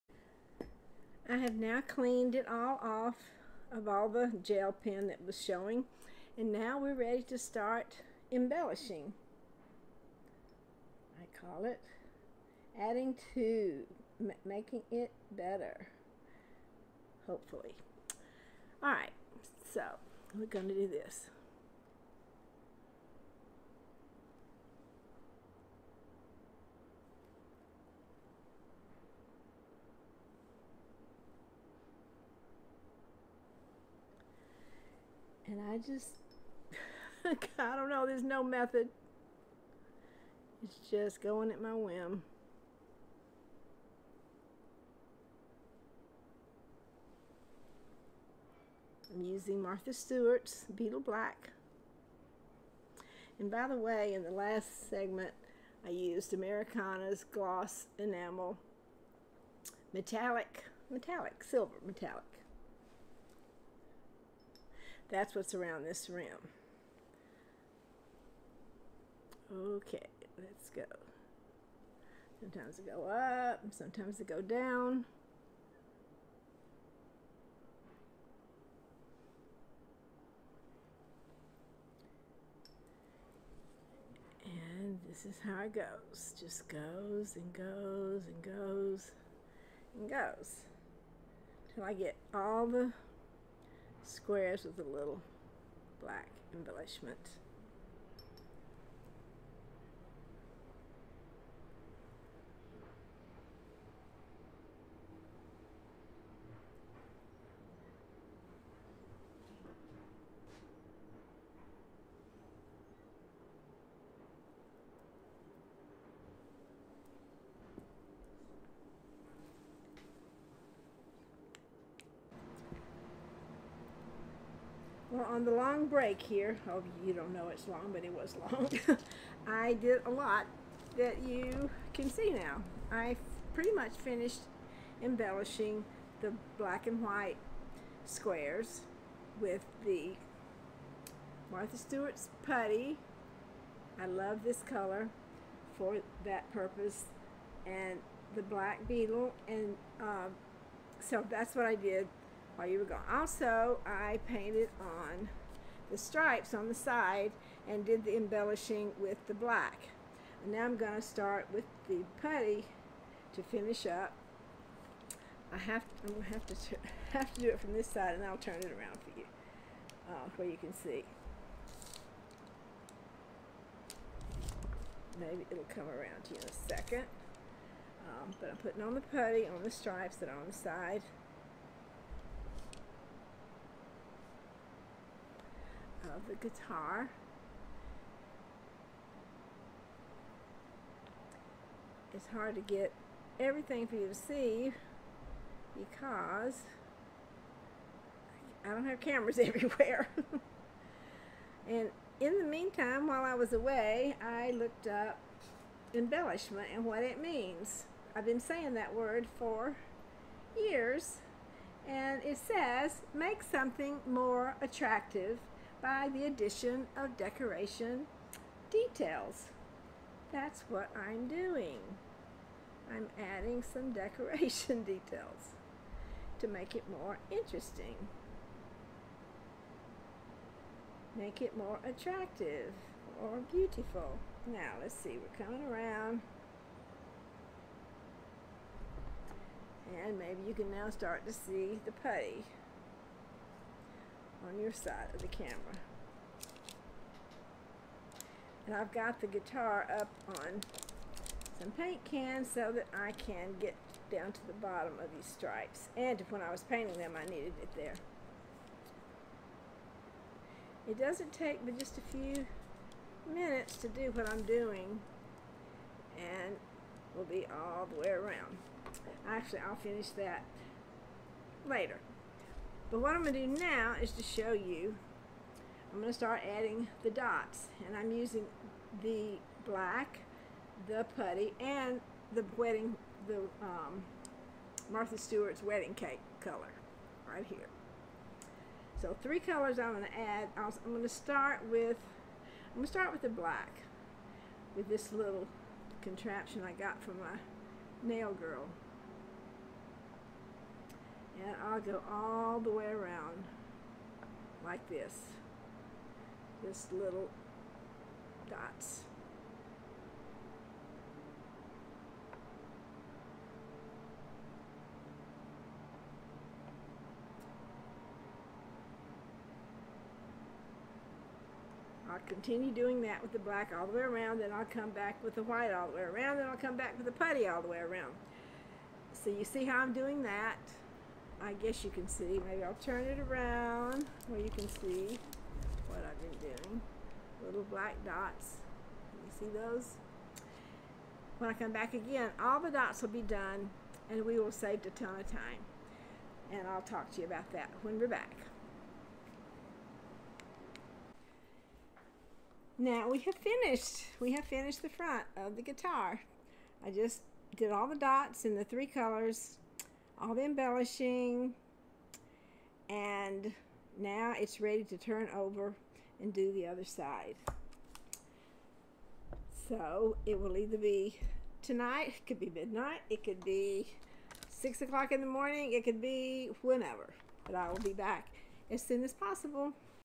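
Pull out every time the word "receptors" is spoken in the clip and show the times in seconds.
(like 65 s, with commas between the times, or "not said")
not said.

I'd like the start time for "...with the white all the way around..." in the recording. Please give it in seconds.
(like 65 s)
325 s.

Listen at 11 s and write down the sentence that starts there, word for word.
I call it adding to, making it better, hopefully.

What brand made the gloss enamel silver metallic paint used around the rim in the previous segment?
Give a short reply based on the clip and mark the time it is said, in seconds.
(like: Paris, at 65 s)
Americana, at 56 s.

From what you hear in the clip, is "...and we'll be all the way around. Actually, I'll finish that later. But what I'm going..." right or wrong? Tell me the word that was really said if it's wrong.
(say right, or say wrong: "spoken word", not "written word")
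right.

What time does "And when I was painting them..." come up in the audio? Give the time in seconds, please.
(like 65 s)
255 s.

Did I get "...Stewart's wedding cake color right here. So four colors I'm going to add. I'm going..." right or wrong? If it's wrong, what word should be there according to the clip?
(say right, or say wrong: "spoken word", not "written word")
wrong: "three", not "four".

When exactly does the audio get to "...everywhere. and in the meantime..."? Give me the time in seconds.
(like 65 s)
199 s.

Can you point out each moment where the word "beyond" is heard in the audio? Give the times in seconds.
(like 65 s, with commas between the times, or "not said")
not said.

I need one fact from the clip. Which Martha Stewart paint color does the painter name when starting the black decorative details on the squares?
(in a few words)
Beetle Black.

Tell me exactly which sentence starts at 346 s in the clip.
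And I'll talk to you about that when we're back.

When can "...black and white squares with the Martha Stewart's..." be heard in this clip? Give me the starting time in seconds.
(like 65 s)
136 s.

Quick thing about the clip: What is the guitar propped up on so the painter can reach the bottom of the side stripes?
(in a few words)
paint cans.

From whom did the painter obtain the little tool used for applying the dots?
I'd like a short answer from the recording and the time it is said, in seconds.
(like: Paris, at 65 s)
nail girl, at 298 s.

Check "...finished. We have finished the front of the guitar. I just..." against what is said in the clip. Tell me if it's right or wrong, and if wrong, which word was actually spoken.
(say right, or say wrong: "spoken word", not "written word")
right.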